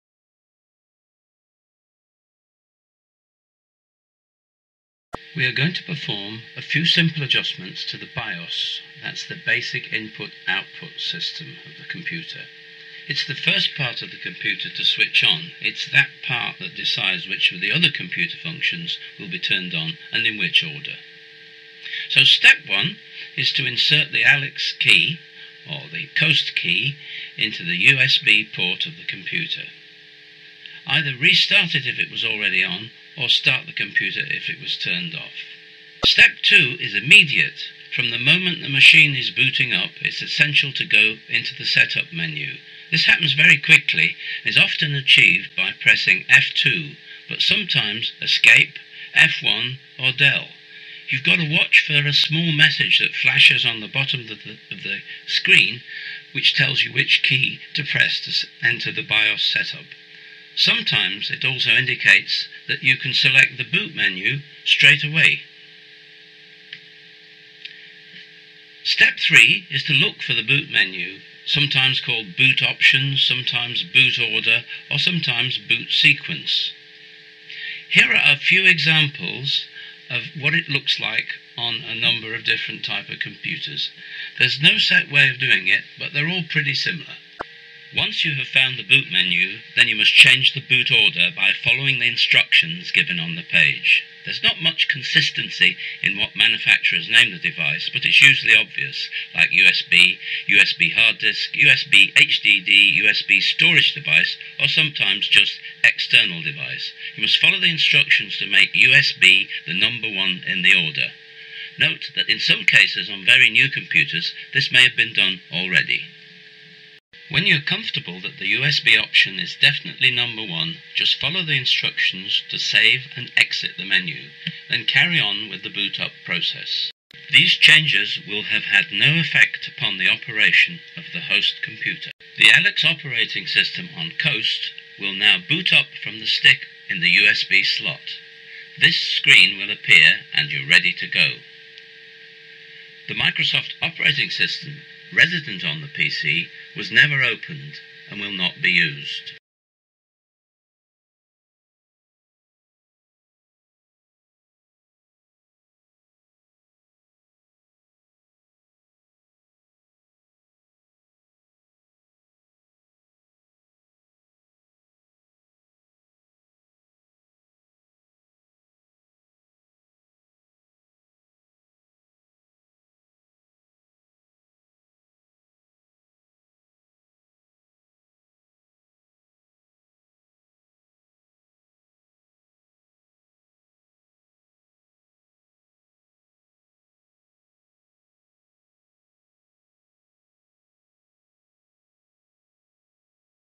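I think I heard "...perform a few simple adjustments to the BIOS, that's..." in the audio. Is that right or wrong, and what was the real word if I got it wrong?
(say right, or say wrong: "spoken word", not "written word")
right.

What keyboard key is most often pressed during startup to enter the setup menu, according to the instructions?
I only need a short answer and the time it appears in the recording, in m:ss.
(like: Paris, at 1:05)
F2, at 0:46.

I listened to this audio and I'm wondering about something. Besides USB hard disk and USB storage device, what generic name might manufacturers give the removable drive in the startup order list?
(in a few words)
external device.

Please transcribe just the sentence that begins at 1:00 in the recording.
Sometimes it also indicates that you can select the boot menu straight away.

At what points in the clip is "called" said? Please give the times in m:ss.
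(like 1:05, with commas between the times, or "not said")
1:12.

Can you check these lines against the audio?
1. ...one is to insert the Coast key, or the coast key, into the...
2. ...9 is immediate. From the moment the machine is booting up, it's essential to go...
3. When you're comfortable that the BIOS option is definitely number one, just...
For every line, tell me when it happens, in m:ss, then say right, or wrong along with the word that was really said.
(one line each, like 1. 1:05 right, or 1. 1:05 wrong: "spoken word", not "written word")
1. 0:22 wrong: "ALEX", not "Coast"
2. 0:36 wrong: "2", not "9"
3. 1:57 wrong: "USB", not "BIOS".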